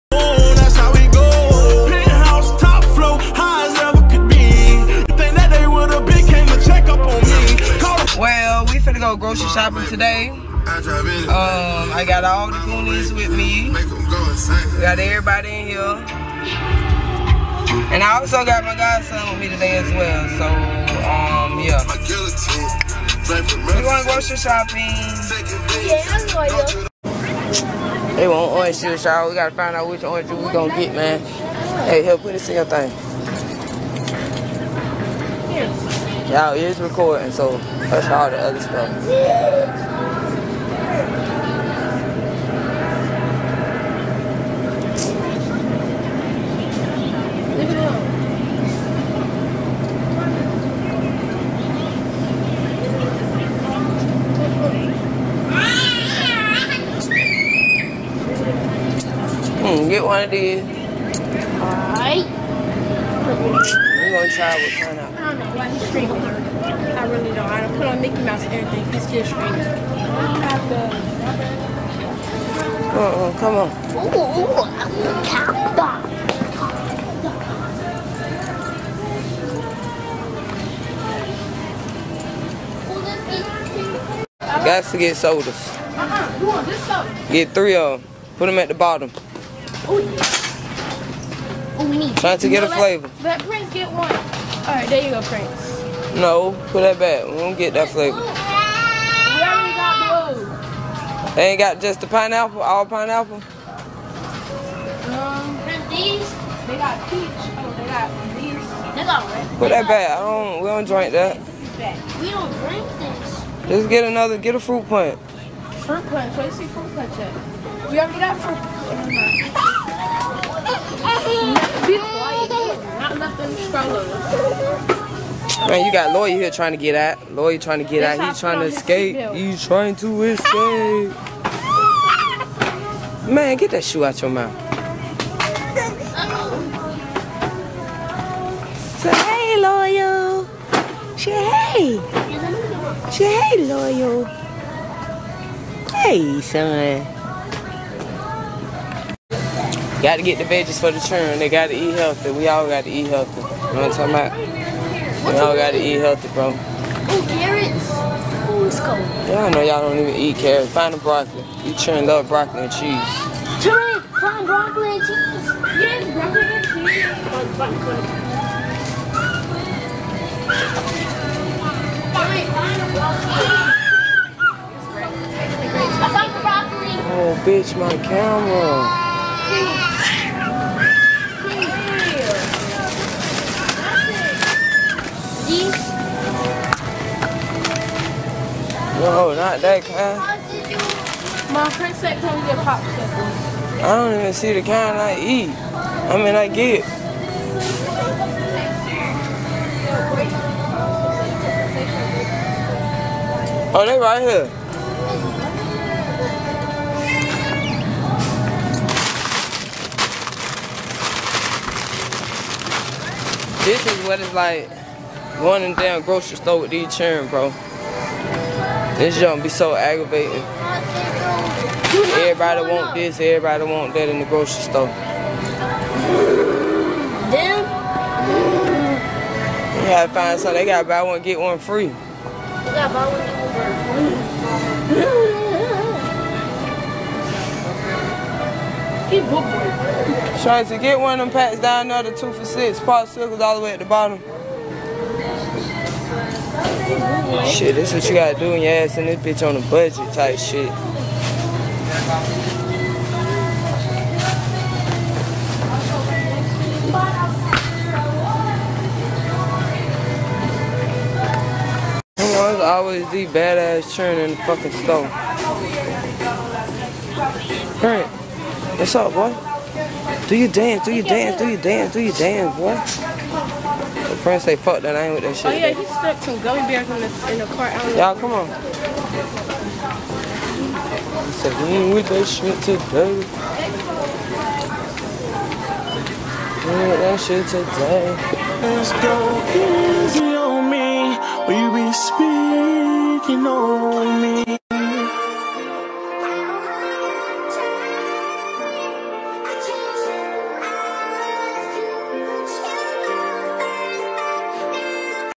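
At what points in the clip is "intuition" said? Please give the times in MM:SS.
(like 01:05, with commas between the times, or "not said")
not said.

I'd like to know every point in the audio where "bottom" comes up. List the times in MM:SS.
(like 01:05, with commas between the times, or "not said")
01:28, 04:03.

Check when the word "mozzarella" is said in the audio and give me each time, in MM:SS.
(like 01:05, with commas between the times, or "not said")
not said.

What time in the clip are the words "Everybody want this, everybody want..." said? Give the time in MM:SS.
03:42.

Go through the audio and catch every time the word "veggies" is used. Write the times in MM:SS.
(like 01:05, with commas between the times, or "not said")
02:30.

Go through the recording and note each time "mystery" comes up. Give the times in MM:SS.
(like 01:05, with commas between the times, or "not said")
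not said.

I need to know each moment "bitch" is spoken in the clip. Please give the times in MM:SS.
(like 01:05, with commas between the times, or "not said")
02:57, 04:09.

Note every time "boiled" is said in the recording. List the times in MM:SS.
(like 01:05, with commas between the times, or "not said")
not said.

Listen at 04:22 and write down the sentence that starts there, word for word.
Someone's always the badass churn in the fucking store.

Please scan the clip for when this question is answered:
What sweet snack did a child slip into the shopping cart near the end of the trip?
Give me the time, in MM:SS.
04:36.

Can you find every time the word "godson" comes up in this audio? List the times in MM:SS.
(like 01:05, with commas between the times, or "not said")
00:18.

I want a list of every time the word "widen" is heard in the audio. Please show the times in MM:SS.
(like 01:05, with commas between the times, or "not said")
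not said.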